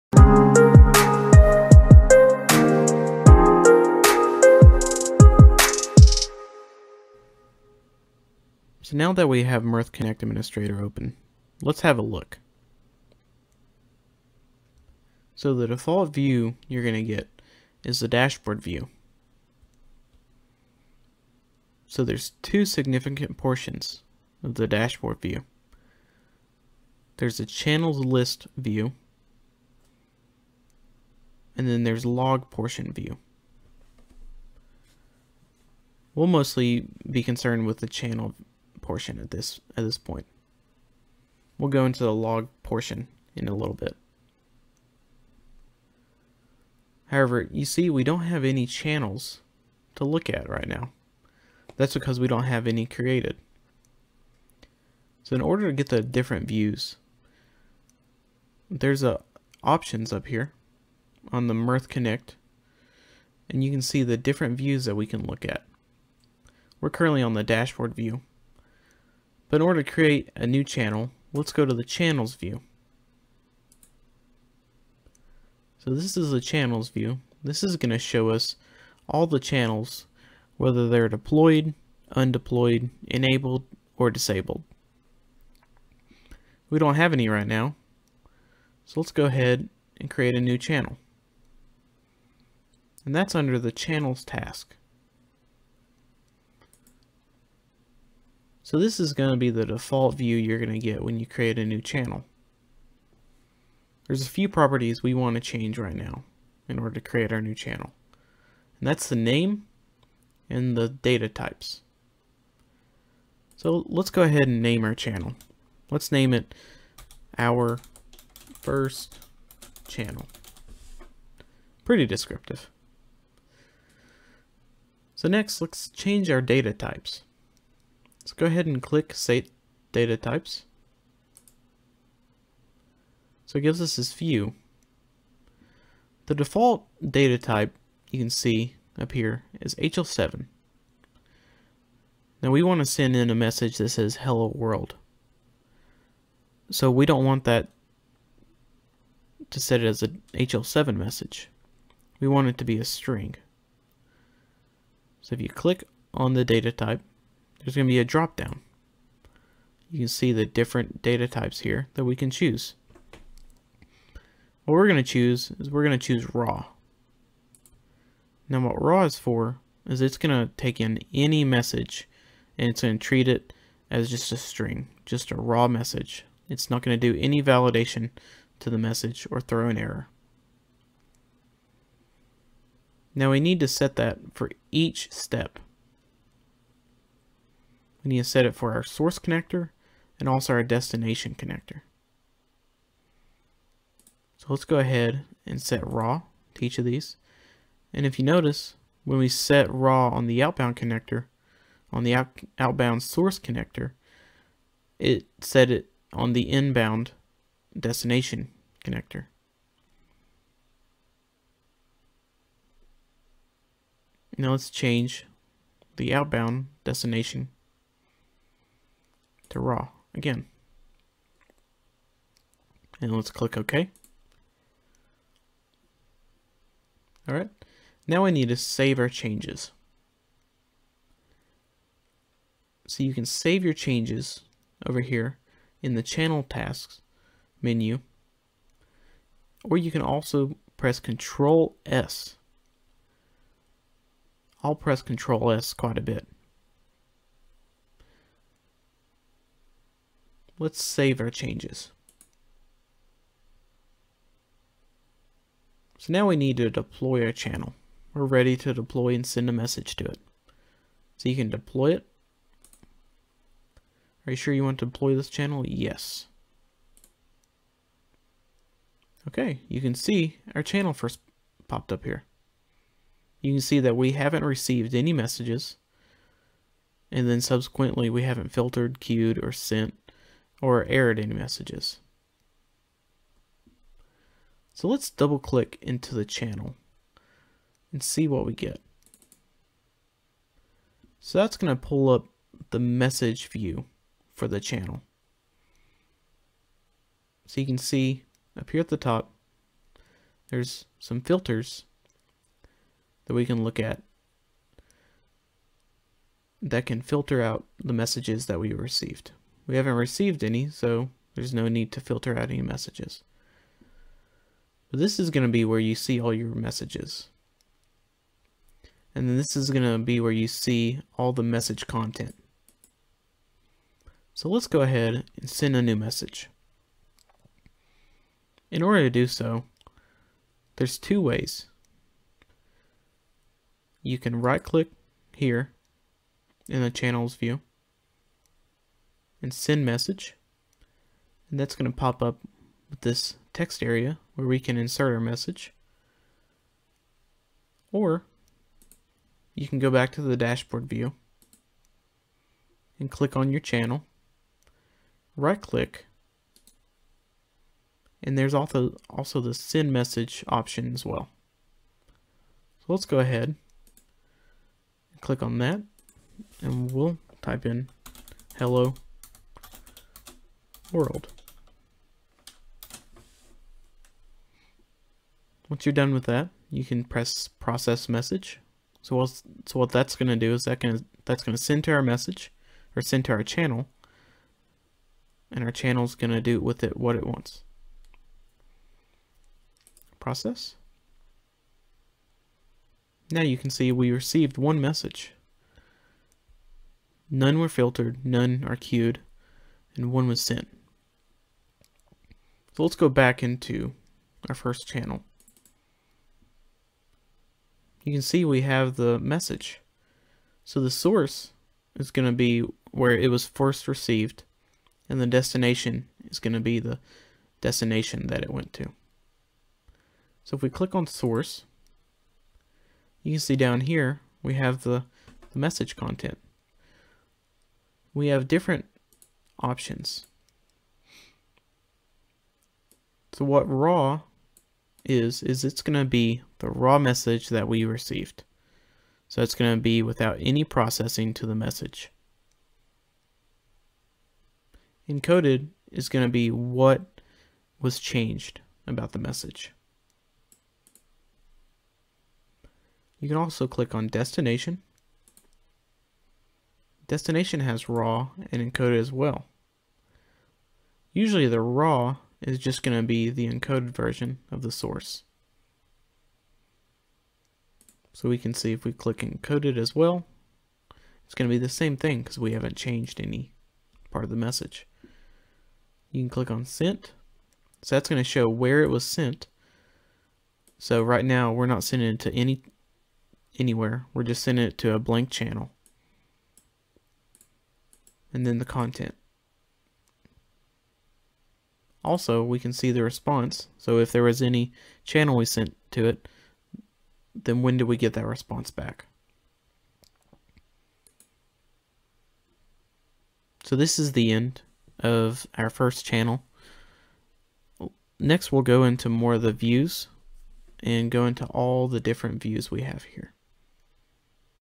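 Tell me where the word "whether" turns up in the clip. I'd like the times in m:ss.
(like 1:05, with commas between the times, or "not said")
1:20.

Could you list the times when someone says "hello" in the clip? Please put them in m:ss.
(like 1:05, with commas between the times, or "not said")
2:24, 6:08.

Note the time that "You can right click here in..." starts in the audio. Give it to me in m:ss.
5:34.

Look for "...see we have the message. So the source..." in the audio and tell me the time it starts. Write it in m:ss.
6:48.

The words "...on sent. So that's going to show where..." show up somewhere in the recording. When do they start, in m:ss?
7:56.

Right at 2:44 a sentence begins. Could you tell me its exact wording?
What we're going to choose is we're going to choose raw.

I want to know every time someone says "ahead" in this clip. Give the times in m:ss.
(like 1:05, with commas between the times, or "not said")
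1:29, 1:54, 2:08, 3:14, 5:24, 6:03.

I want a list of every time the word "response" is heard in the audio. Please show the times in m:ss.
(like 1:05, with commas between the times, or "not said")
8:13, 8:18.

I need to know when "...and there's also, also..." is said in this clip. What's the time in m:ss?
5:58.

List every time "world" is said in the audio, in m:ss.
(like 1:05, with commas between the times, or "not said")
2:24, 6:10.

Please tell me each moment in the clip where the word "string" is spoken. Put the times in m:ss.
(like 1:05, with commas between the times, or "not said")
2:32, 2:54.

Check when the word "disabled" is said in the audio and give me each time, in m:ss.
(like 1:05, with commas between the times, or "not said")
1:24.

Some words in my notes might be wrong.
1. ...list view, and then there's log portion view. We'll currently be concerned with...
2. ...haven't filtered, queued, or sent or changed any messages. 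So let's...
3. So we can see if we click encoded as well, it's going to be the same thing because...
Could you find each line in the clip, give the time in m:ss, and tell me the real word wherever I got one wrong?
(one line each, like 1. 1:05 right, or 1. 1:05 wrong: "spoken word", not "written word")
1. 0:28 wrong: "mostly", not "currently"
2. 4:38 wrong: "aired", not "changed"
3. 7:48 right.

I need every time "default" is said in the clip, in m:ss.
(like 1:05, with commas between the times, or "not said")
0:15, 1:39, 2:16.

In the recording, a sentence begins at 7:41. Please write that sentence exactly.
Usually the raw is just going to be the encoded version of the source.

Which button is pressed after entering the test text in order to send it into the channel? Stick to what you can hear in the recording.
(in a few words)
Process message.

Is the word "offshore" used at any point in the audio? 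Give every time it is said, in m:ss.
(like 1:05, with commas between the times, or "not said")
not said.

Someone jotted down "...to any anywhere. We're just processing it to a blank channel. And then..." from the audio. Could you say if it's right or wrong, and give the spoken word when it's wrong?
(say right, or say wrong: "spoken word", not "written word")
wrong: "sending", not "processing".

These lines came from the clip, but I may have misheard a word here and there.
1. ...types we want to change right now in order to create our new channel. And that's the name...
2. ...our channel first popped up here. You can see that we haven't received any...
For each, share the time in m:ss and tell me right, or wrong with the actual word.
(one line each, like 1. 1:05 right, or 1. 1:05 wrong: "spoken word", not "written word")
1. 1:44 wrong: "properties", not "types"
2. 4:30 right.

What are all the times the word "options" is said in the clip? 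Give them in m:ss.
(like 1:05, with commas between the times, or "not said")
0:59, 6:00, 7:09.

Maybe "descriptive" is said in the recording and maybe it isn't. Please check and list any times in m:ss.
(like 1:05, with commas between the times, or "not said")
2:02.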